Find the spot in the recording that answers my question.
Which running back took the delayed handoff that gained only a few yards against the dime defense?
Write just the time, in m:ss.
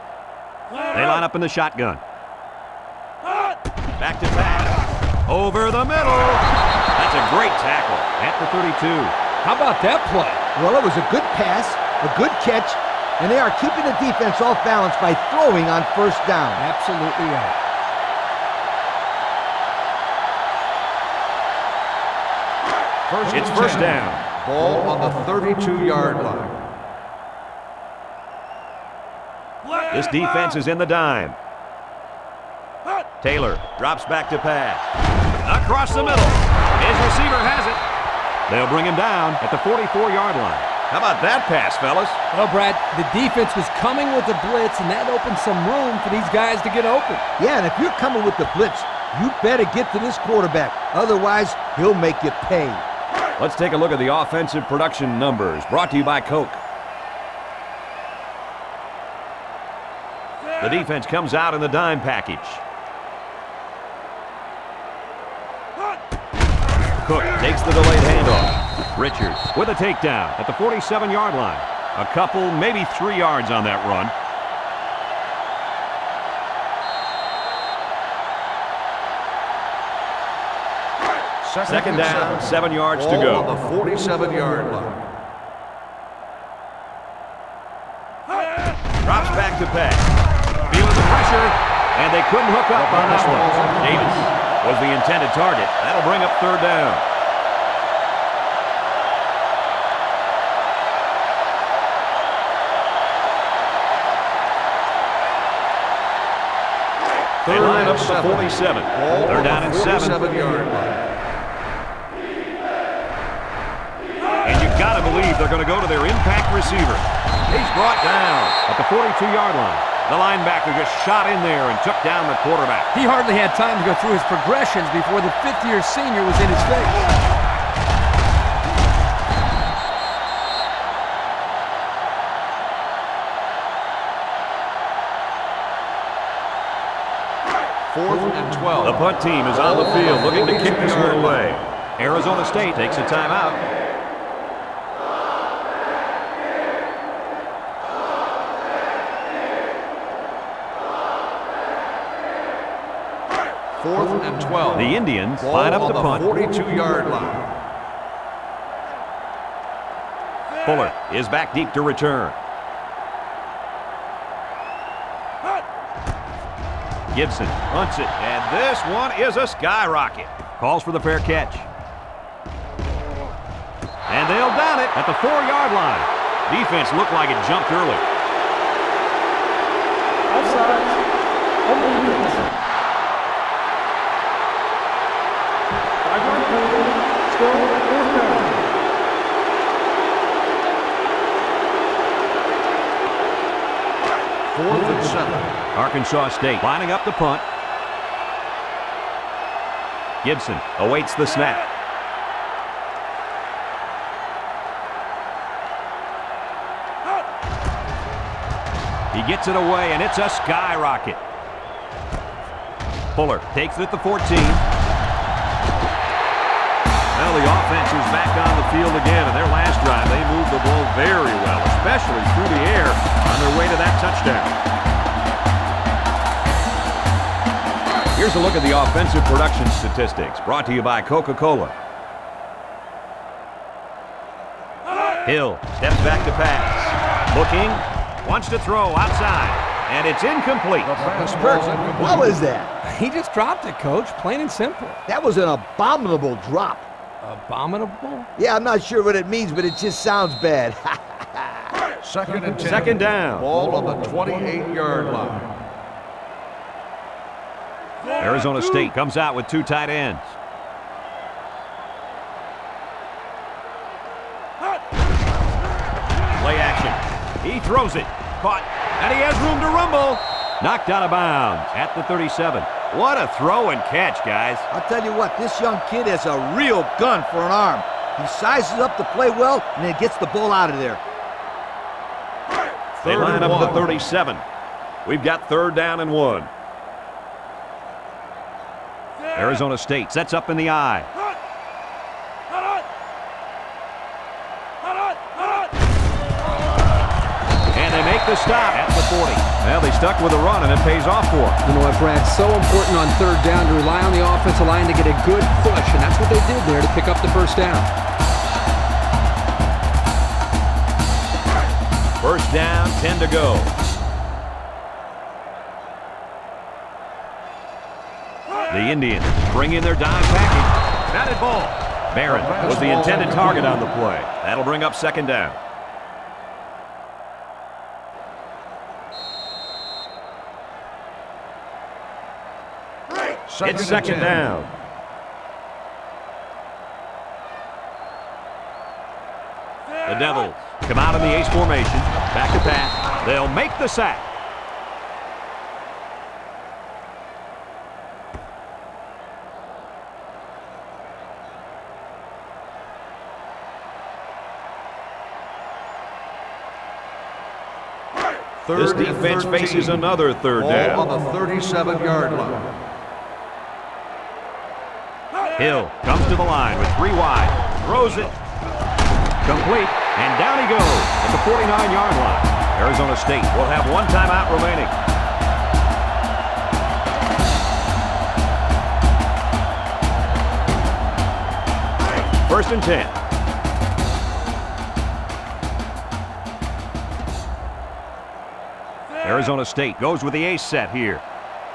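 1:07.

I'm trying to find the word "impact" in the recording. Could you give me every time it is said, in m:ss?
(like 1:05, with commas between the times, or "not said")
1:56.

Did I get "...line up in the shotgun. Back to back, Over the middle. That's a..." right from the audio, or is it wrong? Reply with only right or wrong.
right.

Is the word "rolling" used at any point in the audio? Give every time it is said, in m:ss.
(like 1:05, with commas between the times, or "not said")
not said.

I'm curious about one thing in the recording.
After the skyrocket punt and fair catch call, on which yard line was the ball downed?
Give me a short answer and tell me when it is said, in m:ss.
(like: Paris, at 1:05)
4, at 2:55.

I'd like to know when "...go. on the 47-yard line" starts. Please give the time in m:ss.
1:23.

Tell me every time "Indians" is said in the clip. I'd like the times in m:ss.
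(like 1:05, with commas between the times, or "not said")
2:34, 5:18.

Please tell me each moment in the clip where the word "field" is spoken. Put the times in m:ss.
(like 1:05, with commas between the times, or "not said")
2:19, 3:38.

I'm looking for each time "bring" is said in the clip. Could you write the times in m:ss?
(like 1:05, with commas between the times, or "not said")
0:38, 1:36, 5:19, 5:24.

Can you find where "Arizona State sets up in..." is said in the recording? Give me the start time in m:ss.
4:49.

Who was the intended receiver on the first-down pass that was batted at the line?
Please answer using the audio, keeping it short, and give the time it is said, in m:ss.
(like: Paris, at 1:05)
Barron, at 5:22.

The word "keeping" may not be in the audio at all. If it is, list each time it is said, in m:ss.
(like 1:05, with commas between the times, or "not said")
0:13.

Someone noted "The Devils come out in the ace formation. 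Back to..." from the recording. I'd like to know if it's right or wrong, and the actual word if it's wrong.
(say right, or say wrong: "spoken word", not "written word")
right.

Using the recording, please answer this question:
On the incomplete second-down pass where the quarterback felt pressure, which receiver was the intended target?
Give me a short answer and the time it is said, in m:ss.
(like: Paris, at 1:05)
Davis, at 1:33.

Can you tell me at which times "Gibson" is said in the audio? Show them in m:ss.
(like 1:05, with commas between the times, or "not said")
2:47, 3:20.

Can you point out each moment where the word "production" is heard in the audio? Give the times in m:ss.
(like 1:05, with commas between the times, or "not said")
0:54, 3:49.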